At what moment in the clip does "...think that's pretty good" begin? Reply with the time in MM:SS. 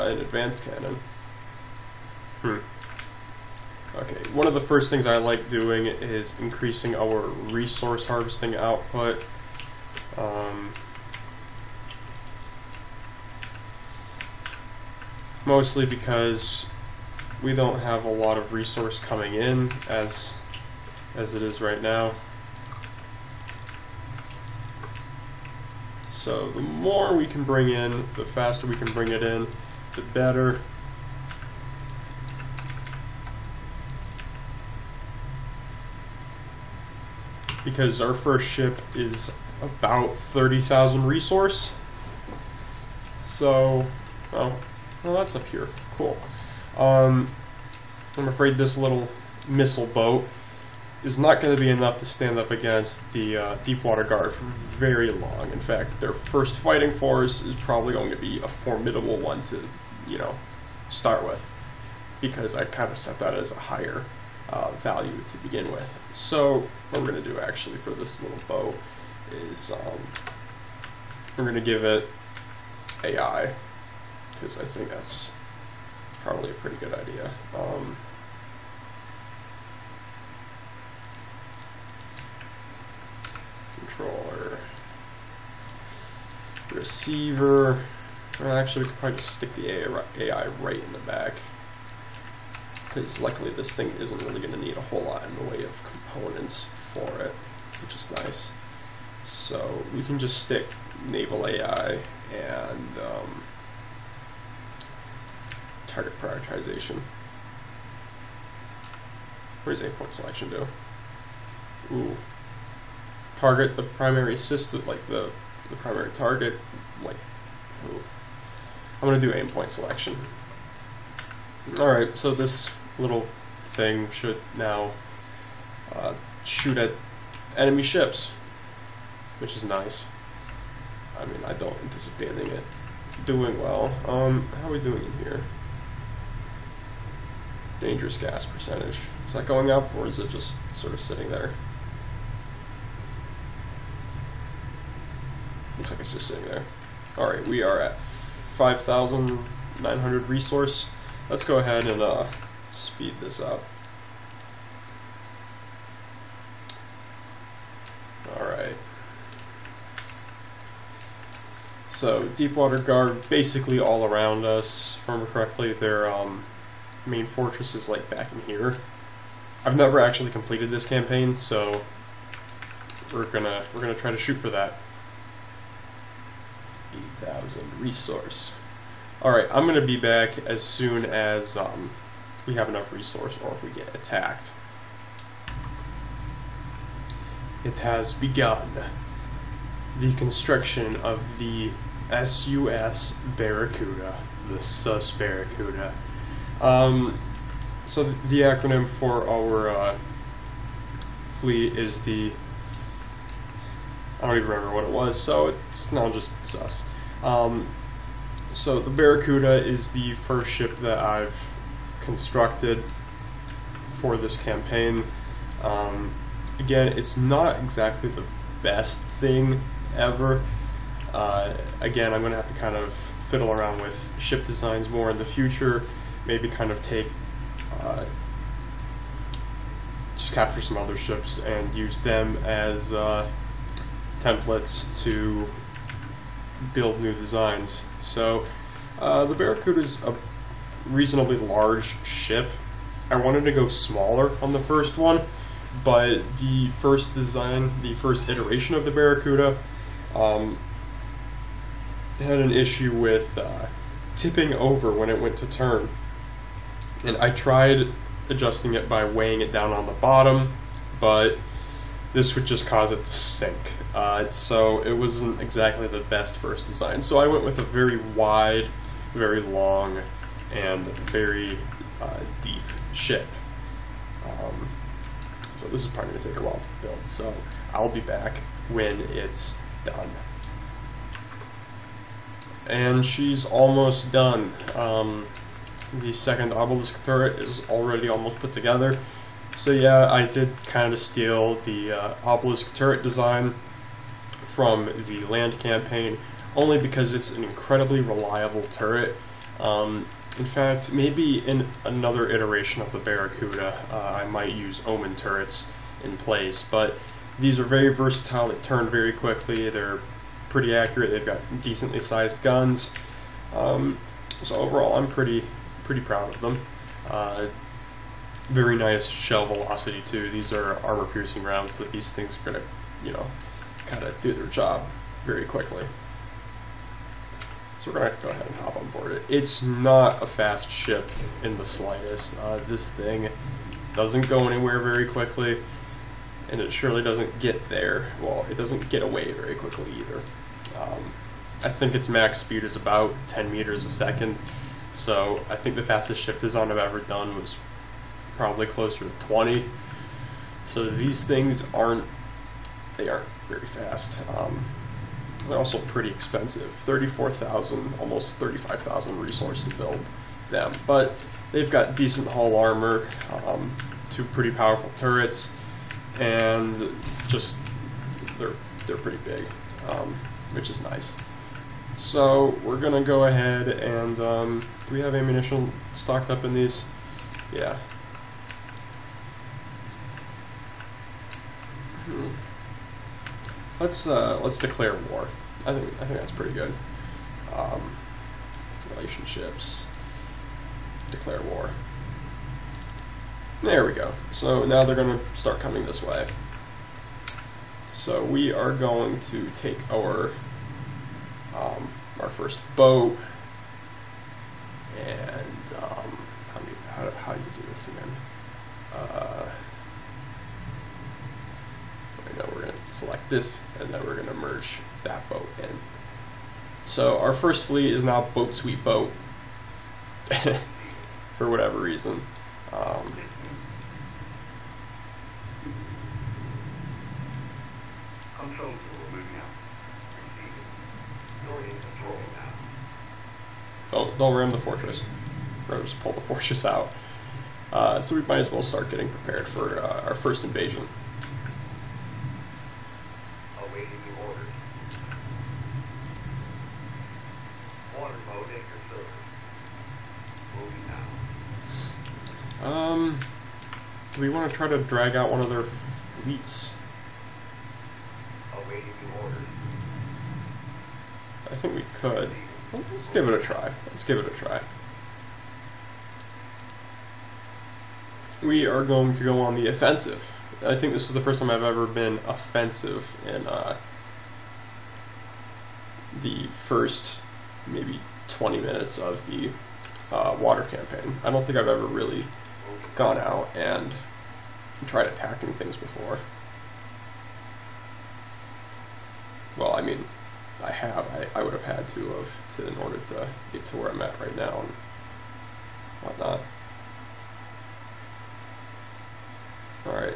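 06:26.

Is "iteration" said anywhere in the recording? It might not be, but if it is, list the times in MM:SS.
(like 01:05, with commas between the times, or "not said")
04:08, 05:02.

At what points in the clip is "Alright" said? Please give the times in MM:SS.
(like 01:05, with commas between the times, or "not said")
02:01, 02:27, 02:38, 02:59.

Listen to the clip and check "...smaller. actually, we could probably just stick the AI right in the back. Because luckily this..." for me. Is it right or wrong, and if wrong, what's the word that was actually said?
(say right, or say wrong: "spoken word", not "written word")
wrong: "receiver", not "smaller".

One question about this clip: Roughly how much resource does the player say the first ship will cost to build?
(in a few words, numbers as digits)
30,000.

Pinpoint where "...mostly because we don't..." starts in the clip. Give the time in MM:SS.
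00:15.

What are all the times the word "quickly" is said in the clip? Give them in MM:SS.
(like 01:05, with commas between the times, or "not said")
05:09, 05:25, 05:35, 05:39.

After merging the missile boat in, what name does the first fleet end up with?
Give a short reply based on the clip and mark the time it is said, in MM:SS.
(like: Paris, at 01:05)
boat sweet boat, at 06:58.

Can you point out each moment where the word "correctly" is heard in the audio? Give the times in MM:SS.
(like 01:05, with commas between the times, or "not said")
02:45.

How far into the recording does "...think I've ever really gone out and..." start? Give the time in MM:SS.
08:01.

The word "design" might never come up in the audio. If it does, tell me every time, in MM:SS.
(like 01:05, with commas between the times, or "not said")
03:44, 03:57, 04:07, 04:26, 04:53, 05:46.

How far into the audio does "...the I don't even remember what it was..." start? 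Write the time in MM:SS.
03:22.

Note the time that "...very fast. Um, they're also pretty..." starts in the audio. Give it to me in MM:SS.
05:53.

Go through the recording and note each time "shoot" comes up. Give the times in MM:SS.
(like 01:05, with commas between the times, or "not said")
02:06, 02:54.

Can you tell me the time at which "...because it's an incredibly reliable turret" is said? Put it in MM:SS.
04:56.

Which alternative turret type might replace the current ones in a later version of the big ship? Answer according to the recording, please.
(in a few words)
Omen turrets.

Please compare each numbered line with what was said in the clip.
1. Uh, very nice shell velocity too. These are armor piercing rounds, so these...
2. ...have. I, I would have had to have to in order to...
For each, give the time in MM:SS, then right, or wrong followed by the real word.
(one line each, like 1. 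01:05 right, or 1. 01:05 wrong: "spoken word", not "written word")
1. 05:17 right
2. 08:10 right.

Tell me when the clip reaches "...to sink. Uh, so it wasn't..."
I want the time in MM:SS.
04:22.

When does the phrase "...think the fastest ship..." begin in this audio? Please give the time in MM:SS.
05:45.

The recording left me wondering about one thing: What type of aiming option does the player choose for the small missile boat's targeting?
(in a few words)
aim point selection.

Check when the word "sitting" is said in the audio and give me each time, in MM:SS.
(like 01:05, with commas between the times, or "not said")
02:20, 02:26.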